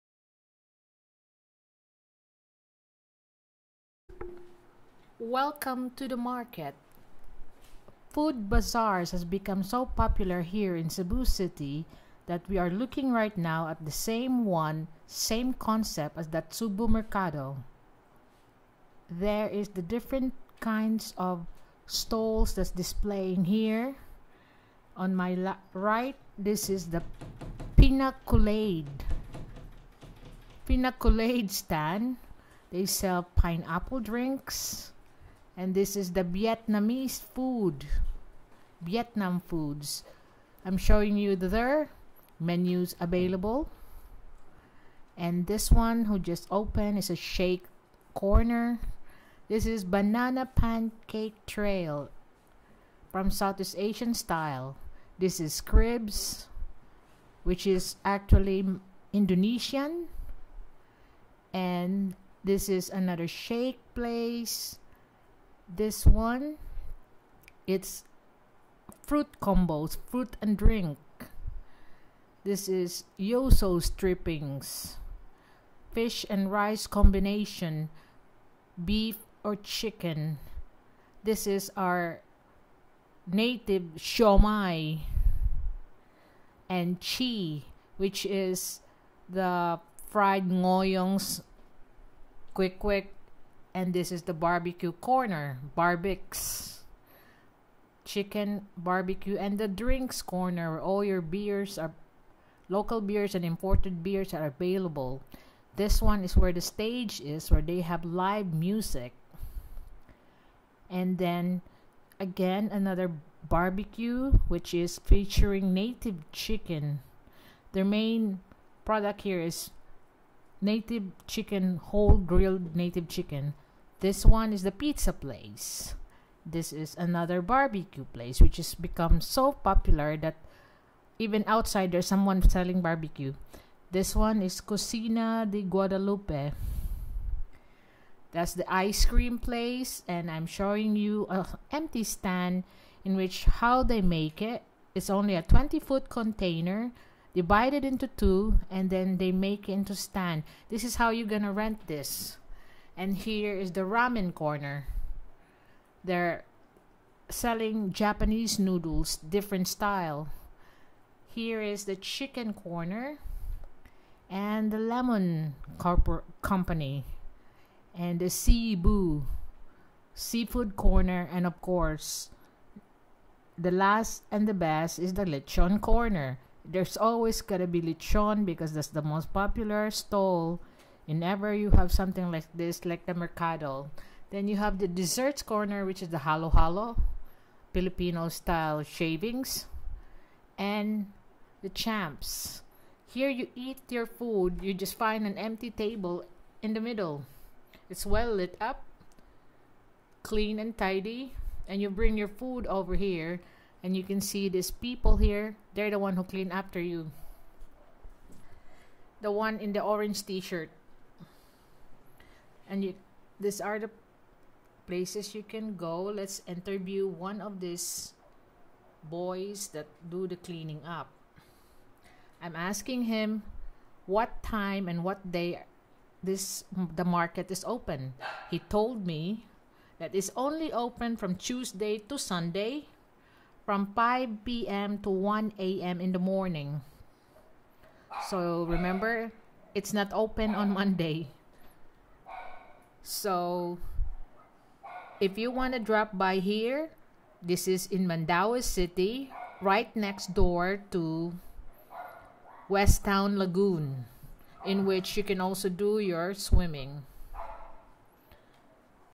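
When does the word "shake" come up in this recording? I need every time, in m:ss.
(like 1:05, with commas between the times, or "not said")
0:47, 1:03.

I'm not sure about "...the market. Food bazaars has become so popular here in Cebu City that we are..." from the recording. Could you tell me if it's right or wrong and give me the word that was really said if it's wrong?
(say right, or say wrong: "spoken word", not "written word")
right.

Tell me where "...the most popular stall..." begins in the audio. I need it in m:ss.
2:58.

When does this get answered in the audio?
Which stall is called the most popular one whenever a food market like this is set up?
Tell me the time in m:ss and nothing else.
2:55.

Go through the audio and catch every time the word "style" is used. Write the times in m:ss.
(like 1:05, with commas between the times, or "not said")
0:54, 2:39, 3:08.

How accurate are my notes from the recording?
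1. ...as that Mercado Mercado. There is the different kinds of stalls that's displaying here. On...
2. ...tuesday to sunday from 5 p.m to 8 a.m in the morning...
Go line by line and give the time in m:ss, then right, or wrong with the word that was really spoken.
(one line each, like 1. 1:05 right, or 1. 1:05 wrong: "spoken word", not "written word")
1. 0:16 wrong: "Cebu", not "Mercado"
2. 3:51 wrong: "1", not "8".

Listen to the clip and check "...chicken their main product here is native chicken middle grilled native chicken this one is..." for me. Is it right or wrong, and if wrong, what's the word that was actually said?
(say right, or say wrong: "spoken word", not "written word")
wrong: "whole", not "middle".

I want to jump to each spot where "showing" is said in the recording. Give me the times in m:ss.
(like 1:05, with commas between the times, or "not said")
0:40, 2:20.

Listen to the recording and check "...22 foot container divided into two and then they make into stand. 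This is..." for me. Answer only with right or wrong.
wrong.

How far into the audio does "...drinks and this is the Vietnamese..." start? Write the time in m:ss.
0:34.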